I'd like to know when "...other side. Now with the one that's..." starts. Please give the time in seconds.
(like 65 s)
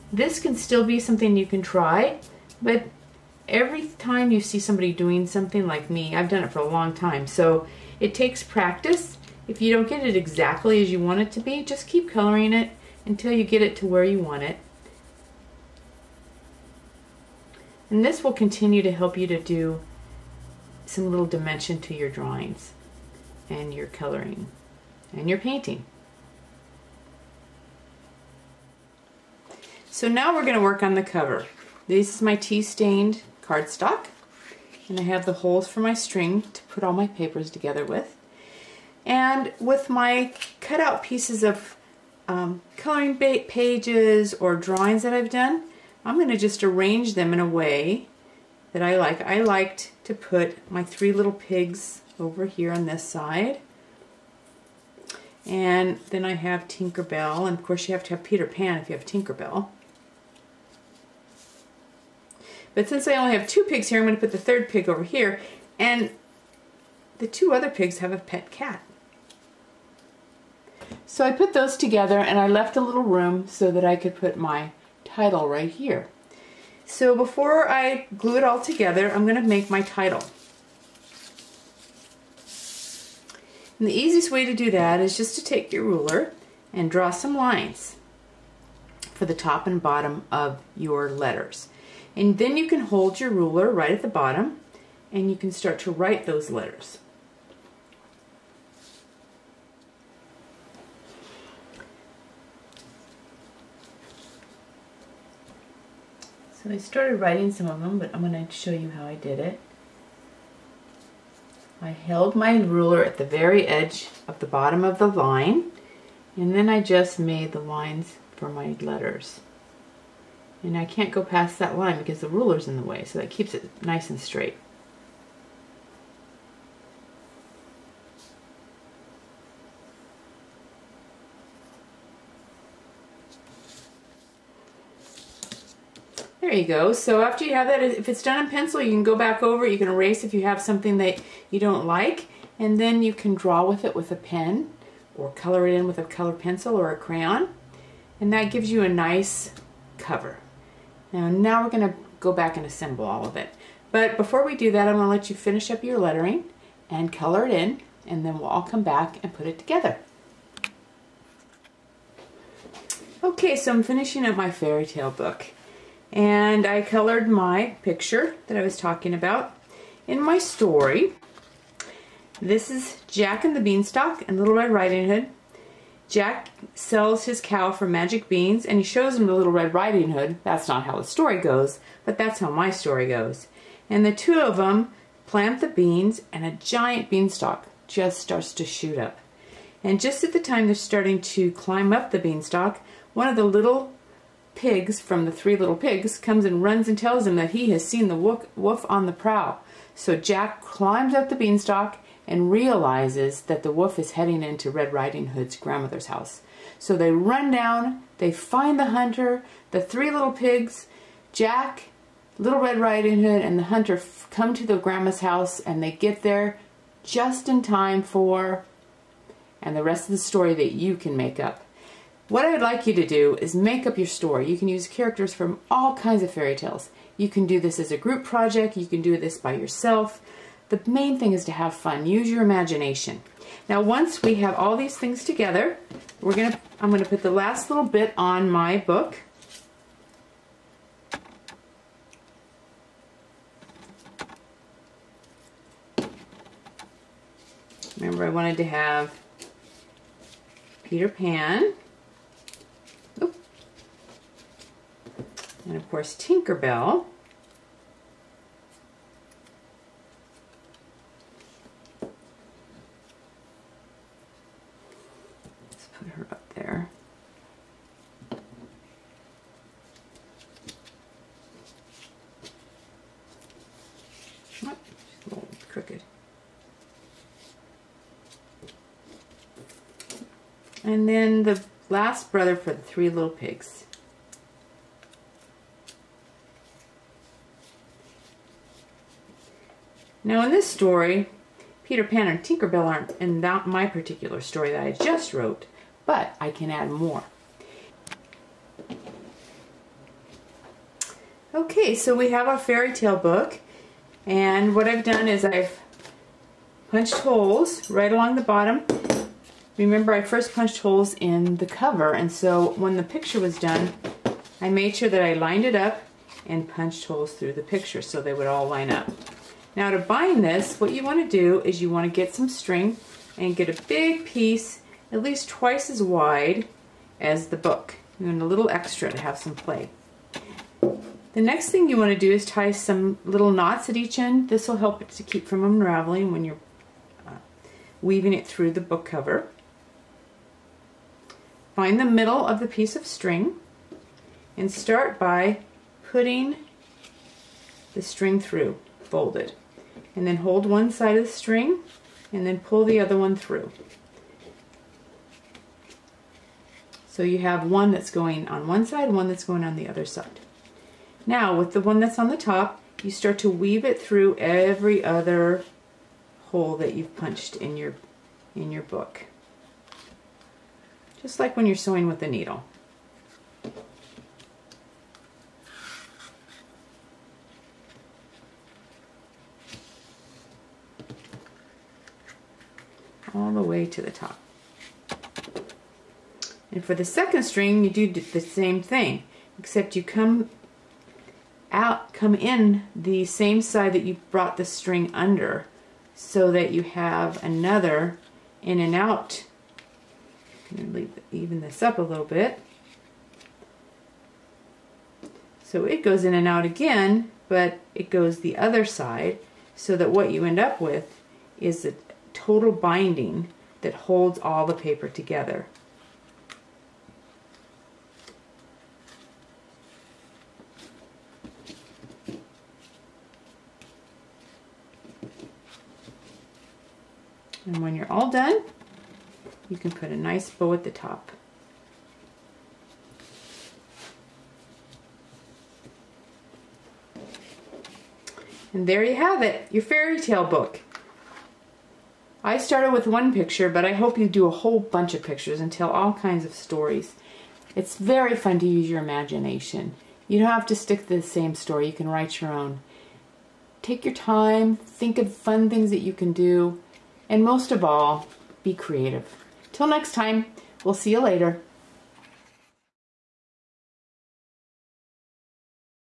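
359 s.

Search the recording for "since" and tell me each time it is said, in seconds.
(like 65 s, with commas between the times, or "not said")
62 s.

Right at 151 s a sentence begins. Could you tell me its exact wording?
Now, now we're going to go back and assemble all of it.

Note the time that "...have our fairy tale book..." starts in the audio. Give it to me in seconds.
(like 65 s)
302 s.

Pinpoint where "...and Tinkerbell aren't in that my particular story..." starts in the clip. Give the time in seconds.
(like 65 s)
292 s.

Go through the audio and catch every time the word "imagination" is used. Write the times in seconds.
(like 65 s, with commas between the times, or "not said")
232 s, 449 s.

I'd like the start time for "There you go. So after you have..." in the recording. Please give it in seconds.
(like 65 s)
136 s.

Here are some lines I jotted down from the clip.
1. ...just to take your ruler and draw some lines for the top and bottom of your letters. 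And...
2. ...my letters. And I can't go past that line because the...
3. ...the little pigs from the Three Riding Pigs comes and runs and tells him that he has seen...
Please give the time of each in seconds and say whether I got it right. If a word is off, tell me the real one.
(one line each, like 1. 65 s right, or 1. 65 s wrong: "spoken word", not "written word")
1. 85 s right
2. 118 s right
3. 193 s wrong: "Little", not "Riding".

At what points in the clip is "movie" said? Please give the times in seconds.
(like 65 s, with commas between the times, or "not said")
not said.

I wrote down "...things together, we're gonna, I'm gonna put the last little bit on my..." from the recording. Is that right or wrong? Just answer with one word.
right.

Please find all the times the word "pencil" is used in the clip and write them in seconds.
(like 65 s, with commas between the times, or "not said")
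138 s, 146 s.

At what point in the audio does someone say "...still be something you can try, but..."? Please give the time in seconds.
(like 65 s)
0 s.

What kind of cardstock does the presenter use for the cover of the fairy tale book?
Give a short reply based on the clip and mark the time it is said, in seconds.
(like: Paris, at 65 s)
Tea stained cardstock, at 32 s.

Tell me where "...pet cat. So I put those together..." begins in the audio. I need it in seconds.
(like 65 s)
68 s.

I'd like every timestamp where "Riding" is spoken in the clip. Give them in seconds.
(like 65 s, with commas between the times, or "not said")
174 s, 179 s, 204 s, 212 s.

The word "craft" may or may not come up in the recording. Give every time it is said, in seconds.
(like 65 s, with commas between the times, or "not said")
not said.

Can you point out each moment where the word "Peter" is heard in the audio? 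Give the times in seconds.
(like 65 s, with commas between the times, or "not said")
58 s, 250 s, 291 s.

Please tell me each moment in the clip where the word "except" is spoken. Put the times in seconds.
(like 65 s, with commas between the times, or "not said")
389 s.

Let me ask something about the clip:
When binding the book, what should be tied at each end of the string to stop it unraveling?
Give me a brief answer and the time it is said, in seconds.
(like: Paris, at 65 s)
Little knots, at 333 s.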